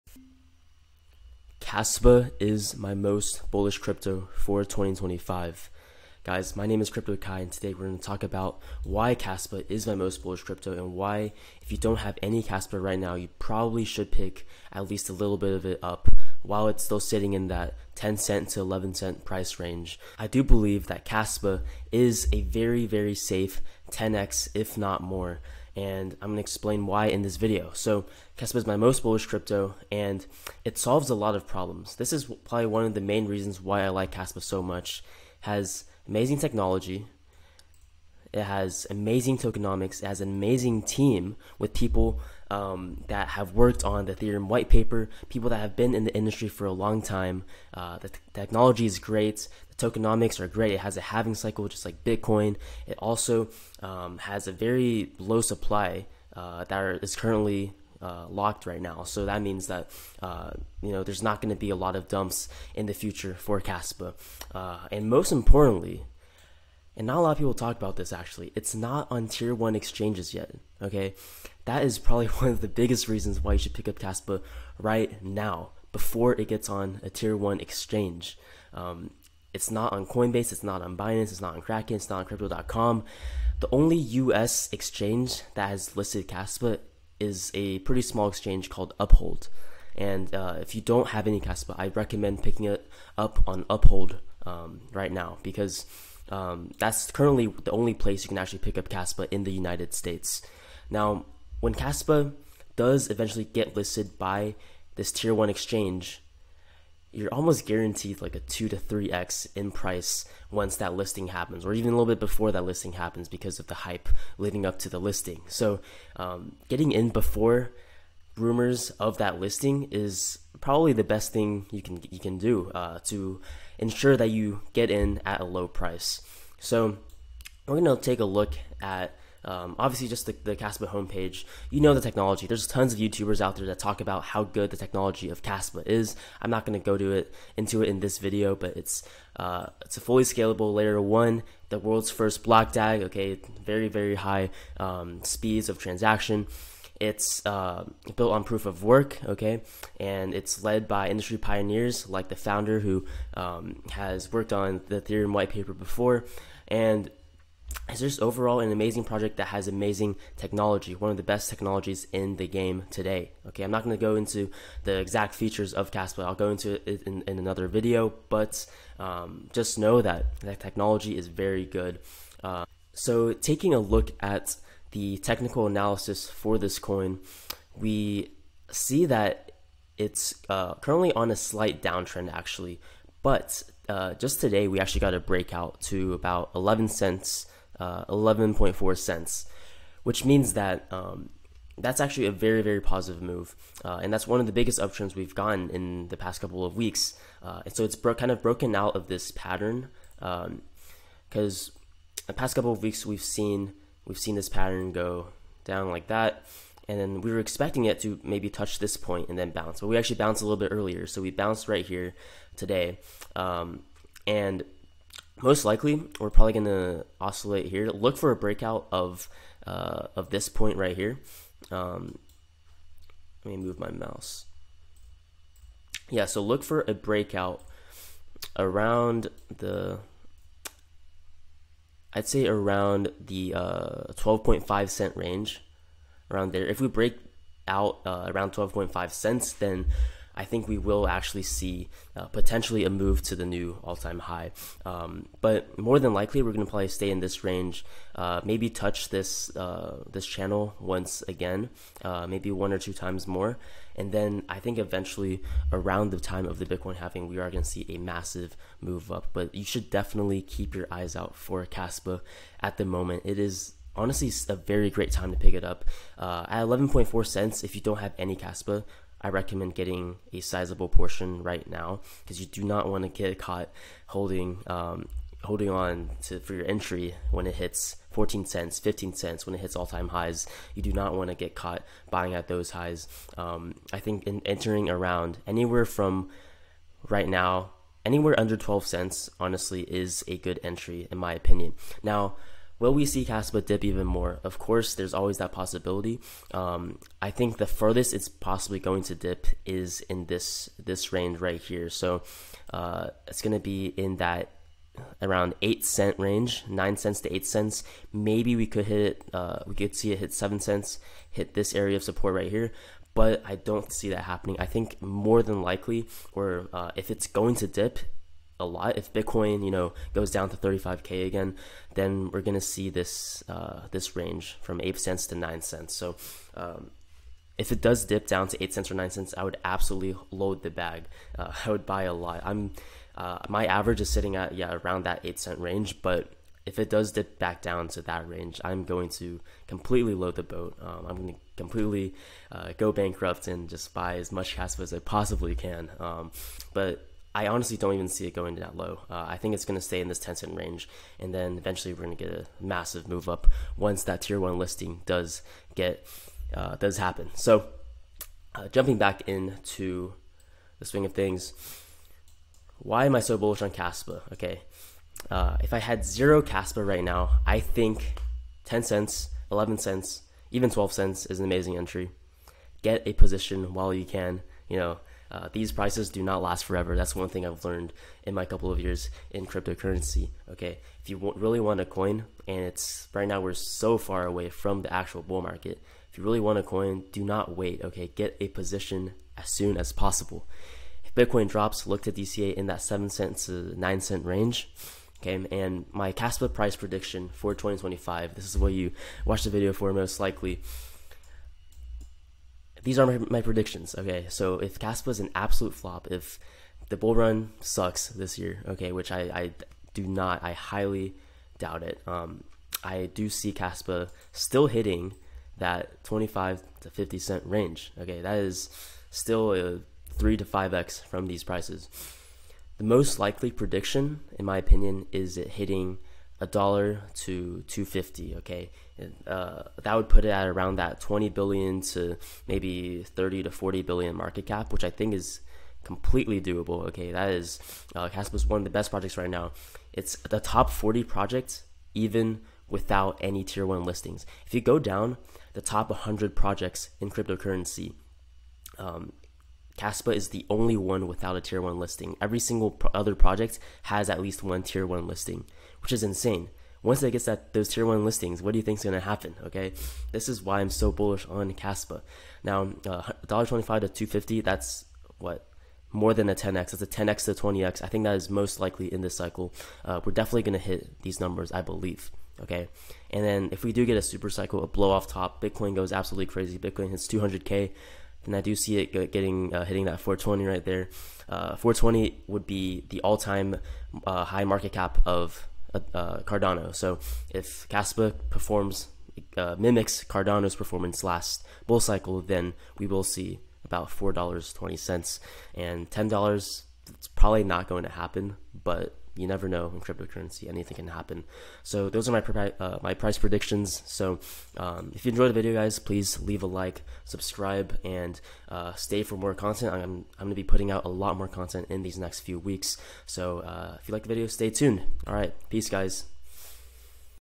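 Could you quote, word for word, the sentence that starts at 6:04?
Okay, uh, if I had zero Kaspa right now, I think 10 cents, 11 cents, even 12 cents is an amazing entry.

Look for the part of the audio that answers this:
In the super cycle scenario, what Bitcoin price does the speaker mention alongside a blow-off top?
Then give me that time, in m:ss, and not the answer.
7:57.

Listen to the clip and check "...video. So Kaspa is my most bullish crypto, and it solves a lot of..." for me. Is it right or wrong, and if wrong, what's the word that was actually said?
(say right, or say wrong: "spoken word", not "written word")
right.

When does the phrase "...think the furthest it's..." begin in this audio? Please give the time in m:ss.
4:57.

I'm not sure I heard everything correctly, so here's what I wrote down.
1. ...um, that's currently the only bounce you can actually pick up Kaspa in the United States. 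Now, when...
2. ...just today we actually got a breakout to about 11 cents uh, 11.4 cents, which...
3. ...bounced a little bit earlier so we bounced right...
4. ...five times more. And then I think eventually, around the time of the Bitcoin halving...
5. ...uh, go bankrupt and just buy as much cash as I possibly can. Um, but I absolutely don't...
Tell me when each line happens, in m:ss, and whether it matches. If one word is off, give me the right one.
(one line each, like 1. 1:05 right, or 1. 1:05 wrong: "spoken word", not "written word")
1. 1:36 wrong: "place", not "bounce"
2. 3:04 right
3. 3:30 right
4. 4:12 wrong: "two", not "five"
5. 5:42 wrong: "honestly", not "absolutely".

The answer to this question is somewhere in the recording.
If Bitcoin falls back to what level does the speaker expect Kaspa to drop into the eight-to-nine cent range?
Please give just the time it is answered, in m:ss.
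5:20.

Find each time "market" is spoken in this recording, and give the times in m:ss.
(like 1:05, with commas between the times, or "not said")
6:25, 7:14, 8:04.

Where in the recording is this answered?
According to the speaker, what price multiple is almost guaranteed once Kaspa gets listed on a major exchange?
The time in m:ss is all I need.
1:48.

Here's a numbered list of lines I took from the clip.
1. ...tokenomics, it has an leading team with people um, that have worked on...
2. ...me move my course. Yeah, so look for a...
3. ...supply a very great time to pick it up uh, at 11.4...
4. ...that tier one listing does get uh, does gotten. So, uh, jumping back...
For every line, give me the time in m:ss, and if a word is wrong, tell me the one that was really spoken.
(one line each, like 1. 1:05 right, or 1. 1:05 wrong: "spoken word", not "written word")
1. 0:39 wrong: "amazing", not "leading"
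2. 3:43 wrong: "mouse", not "course"
3. 4:23 wrong: "honestly", not "supply"
4. 5:54 wrong: "happen", not "gotten".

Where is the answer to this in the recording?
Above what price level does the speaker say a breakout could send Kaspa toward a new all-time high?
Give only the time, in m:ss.
3:58.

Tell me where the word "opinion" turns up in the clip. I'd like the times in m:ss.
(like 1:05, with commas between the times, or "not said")
4:51, 7:04.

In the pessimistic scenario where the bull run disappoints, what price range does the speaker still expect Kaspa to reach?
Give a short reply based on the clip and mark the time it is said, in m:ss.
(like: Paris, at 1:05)
25 to 50 cents, at 6:56.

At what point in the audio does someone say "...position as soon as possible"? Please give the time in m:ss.
6:28.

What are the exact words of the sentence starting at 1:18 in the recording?
Um, it's not on Coinbase, it's not on Binance, it's not on Kraken, it's not on Crypto.com.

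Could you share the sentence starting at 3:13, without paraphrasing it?
Uh, and that's one of the biggest uptrends we've gotten in the past couple of weeks.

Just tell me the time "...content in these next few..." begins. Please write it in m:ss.
8:31.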